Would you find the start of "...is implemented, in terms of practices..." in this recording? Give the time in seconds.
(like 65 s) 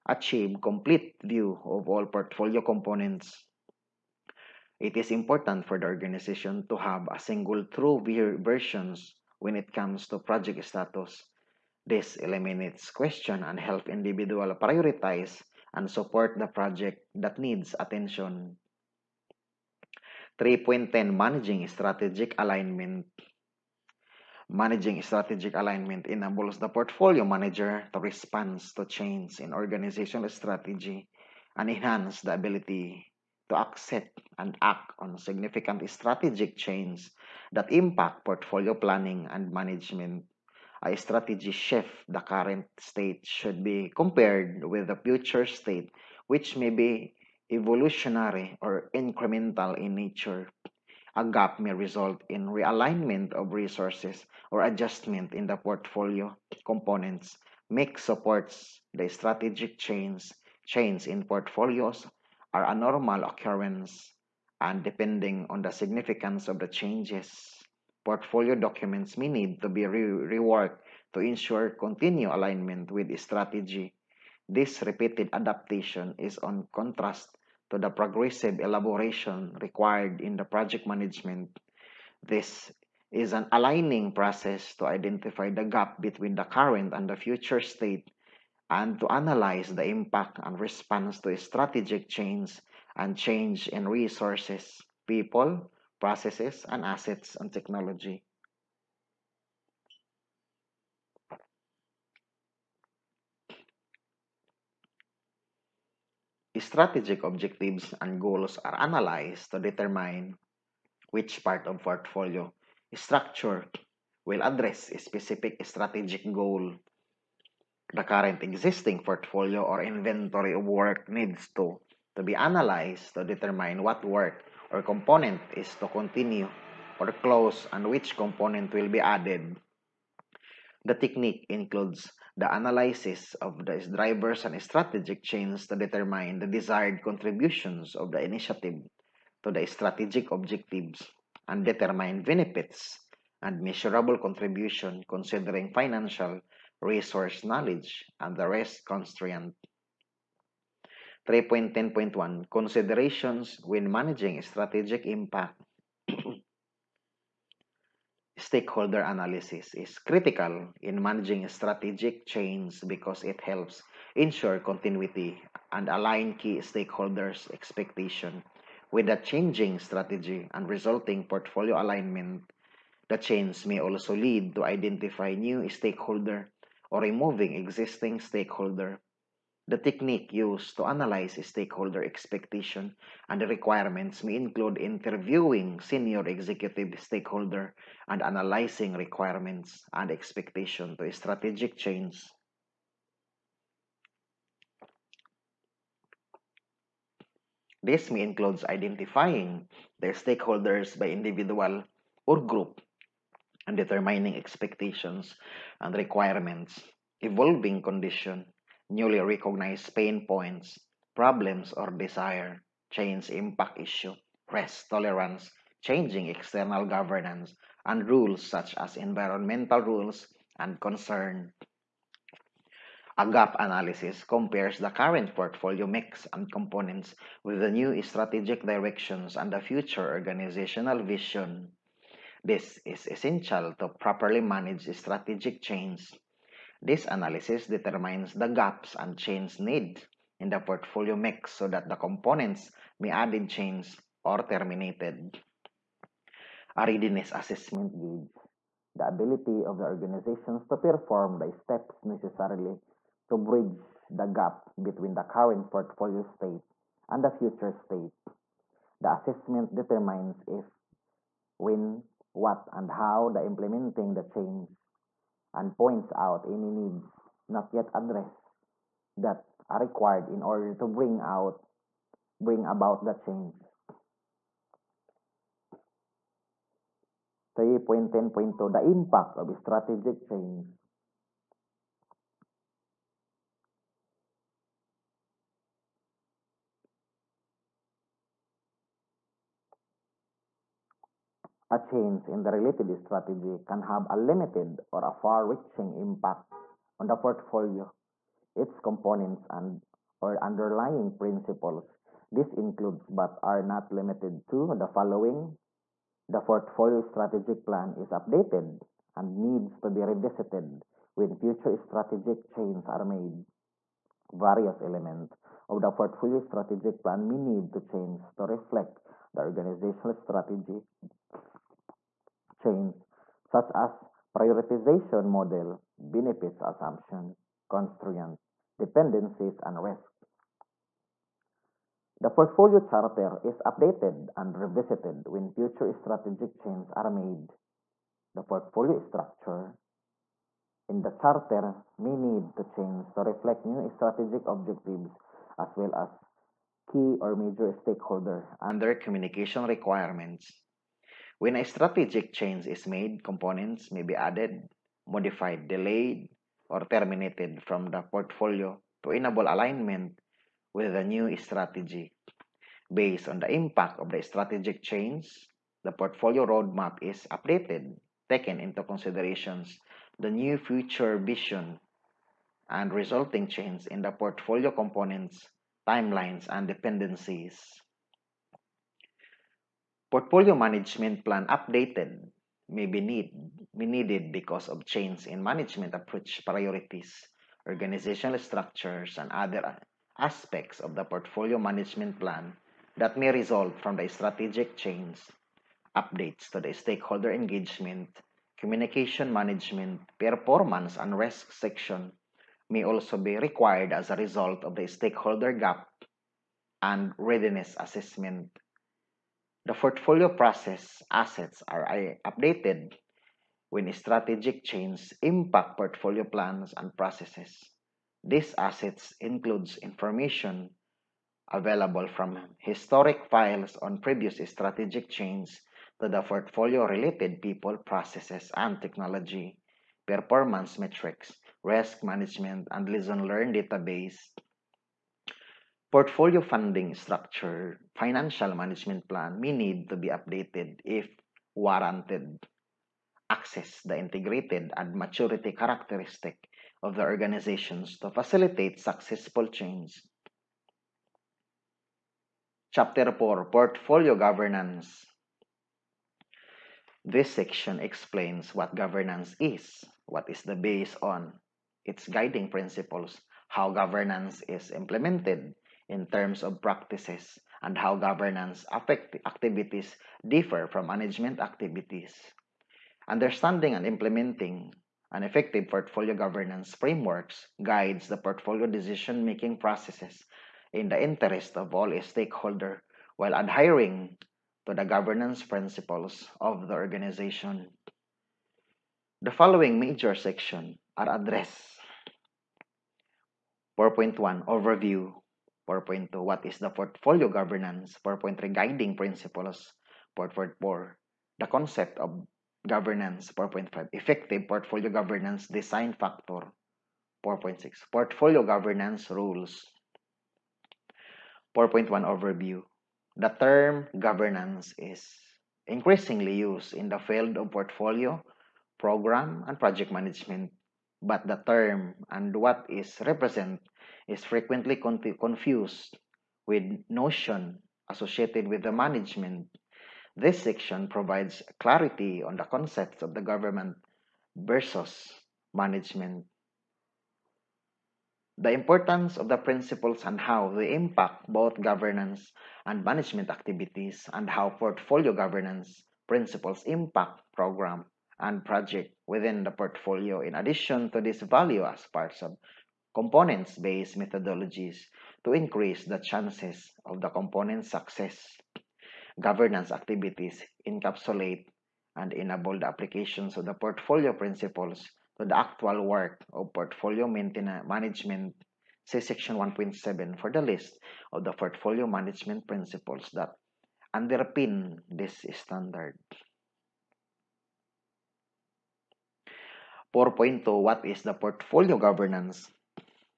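464 s.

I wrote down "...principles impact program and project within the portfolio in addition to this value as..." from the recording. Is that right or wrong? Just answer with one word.
right.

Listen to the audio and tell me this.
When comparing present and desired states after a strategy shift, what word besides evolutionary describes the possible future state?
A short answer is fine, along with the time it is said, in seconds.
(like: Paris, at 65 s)
Incremental, at 48 s.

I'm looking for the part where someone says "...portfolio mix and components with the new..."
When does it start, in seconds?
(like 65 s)
225 s.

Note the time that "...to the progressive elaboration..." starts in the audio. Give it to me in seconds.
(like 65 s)
77 s.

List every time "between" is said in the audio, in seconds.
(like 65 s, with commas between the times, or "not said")
86 s, 254 s.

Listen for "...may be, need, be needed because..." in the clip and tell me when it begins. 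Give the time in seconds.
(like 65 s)
382 s.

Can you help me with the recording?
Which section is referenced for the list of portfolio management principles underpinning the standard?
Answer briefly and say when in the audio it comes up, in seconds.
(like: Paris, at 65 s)
Section 1.7, at 569 s.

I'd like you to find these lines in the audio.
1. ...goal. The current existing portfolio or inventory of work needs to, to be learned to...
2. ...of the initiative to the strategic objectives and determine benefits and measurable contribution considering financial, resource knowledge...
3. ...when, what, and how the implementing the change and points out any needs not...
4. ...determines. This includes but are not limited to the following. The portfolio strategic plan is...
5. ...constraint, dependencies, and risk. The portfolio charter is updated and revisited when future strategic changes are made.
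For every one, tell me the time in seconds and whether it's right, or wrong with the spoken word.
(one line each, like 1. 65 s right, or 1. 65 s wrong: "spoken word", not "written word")
1. 116 s wrong: "analyzed", not "learned"
2. 137 s right
3. 261 s right
4. 301 s wrong: "principles", not "determines"
5. 327 s right.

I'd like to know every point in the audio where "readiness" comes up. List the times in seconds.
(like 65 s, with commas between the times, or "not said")
246 s, 407 s.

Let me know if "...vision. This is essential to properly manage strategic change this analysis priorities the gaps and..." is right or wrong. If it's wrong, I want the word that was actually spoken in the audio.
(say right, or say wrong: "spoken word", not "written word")
wrong: "determines", not "priorities".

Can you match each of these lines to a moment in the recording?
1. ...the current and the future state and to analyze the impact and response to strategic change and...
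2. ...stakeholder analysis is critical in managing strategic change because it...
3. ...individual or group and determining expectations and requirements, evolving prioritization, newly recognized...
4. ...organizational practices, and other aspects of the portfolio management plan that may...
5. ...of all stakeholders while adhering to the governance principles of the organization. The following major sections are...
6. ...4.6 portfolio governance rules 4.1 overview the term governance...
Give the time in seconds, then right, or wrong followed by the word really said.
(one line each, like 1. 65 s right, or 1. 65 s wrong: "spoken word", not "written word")
1. 86 s right
2. 158 s right
3. 201 s wrong: "condition", not "prioritization"
4. 387 s wrong: "structures", not "practices"
5. 481 s right
6. 507 s right.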